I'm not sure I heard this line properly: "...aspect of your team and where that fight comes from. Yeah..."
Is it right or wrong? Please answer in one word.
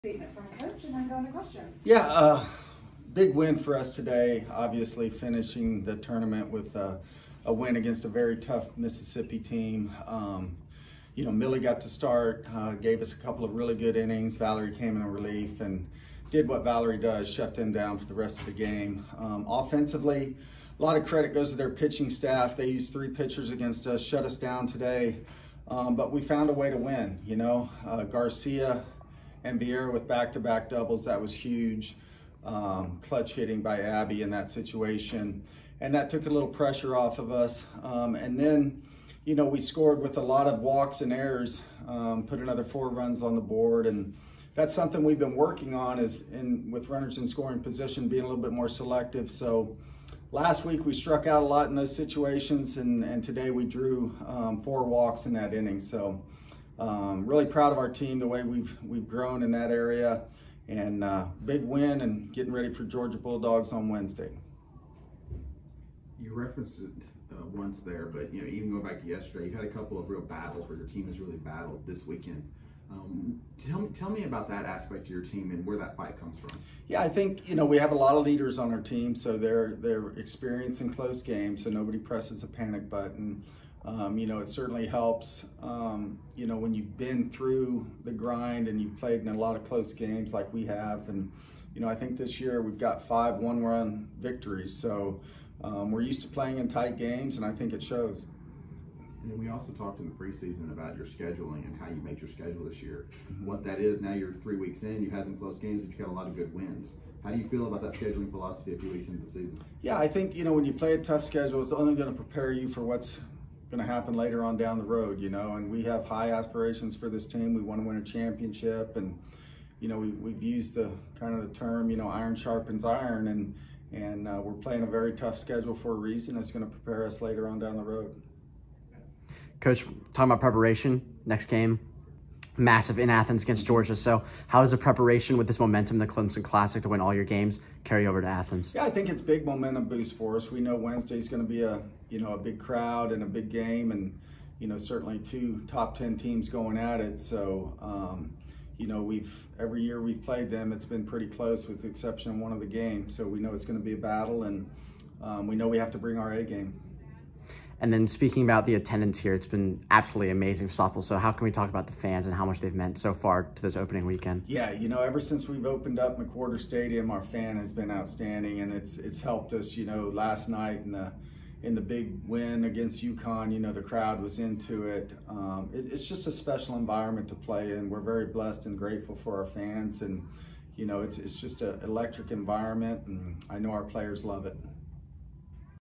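right.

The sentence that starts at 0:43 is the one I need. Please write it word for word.
And that's something we've been working on is in with runners in scoring position, being a little bit more selective.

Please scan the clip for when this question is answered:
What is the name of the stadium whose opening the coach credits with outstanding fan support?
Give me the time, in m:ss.
2:46.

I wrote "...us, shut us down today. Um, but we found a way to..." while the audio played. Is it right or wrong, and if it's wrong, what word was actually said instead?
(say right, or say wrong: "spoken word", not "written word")
right.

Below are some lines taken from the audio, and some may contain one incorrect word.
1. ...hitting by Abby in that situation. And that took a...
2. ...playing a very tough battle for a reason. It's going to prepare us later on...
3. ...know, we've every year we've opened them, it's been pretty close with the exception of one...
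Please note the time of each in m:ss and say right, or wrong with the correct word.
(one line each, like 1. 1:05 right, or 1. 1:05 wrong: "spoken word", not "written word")
1. 0:33 right
2. 2:04 wrong: "schedule", not "battle"
3. 2:28 wrong: "played", not "opened".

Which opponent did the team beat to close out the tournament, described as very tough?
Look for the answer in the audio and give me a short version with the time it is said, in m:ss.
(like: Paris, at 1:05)
Mississippi, at 0:08.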